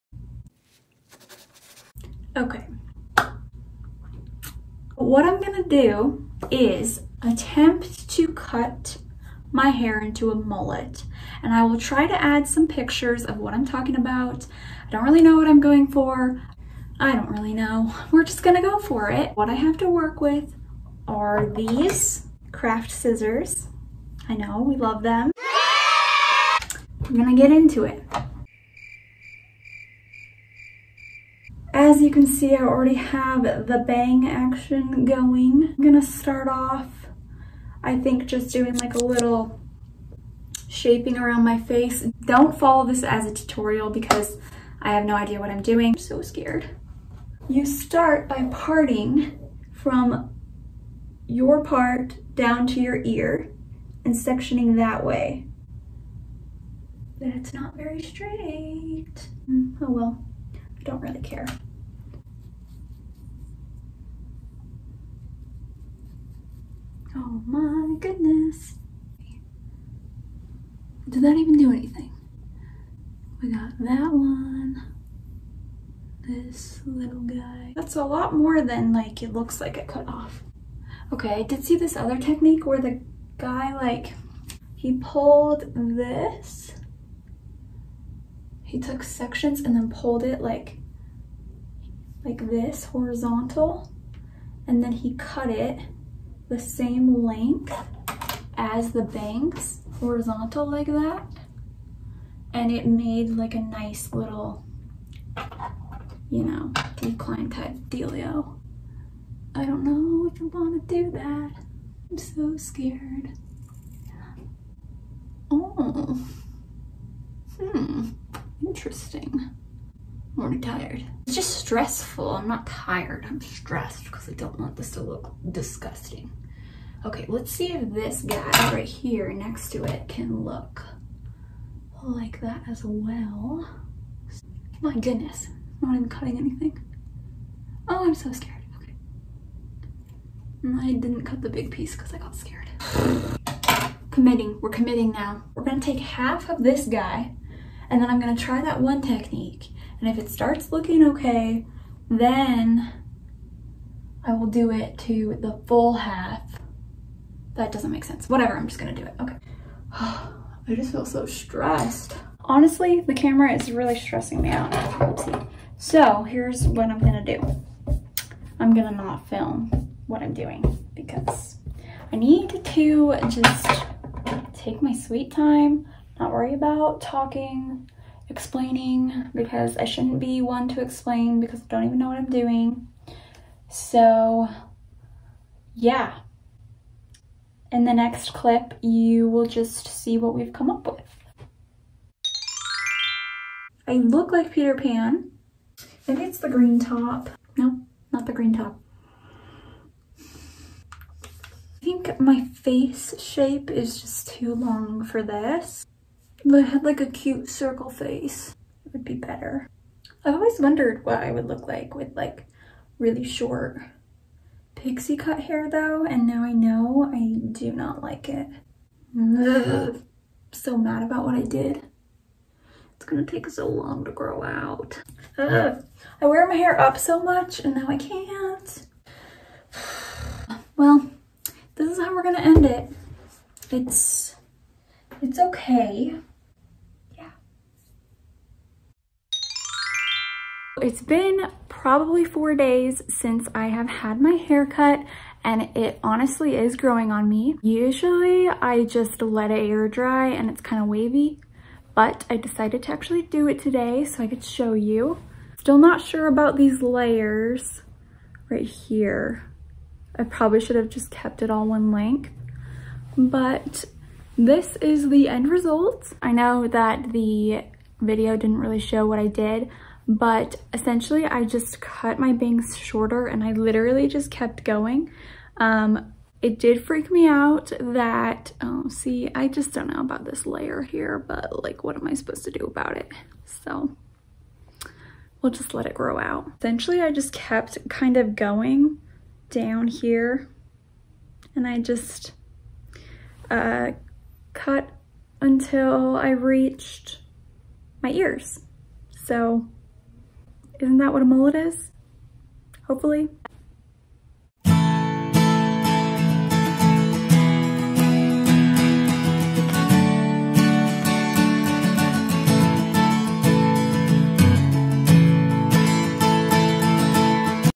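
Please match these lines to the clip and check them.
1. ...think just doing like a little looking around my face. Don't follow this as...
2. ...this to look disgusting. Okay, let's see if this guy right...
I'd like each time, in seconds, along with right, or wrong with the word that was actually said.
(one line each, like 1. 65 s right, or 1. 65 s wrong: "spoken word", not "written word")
1. 37 s wrong: "shaping", not "looking"
2. 124 s right.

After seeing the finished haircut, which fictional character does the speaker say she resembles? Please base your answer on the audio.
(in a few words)
Peter Pan.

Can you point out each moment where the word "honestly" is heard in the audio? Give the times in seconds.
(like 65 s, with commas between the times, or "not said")
162 s, 246 s.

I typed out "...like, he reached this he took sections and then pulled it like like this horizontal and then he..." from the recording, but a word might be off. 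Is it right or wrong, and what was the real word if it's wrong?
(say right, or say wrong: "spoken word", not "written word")
wrong: "pulled", not "reached".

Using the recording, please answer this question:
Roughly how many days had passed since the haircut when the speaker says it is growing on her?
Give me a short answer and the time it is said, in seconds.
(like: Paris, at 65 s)
4, at 242 s.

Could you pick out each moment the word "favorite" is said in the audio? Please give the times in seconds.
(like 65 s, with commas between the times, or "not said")
not said.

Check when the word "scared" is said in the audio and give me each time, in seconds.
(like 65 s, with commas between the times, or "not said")
46 s, 112 s, 138 s, 142 s.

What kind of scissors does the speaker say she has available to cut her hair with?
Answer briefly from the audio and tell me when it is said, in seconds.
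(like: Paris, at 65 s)
craft scissors, at 22 s.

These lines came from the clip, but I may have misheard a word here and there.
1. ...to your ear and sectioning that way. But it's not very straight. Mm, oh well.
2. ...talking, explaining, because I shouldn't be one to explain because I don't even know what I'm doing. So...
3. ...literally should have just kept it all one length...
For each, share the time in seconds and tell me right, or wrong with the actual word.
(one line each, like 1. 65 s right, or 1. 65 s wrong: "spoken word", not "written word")
1. 52 s right
2. 177 s right
3. 260 s wrong: "probably", not "literally".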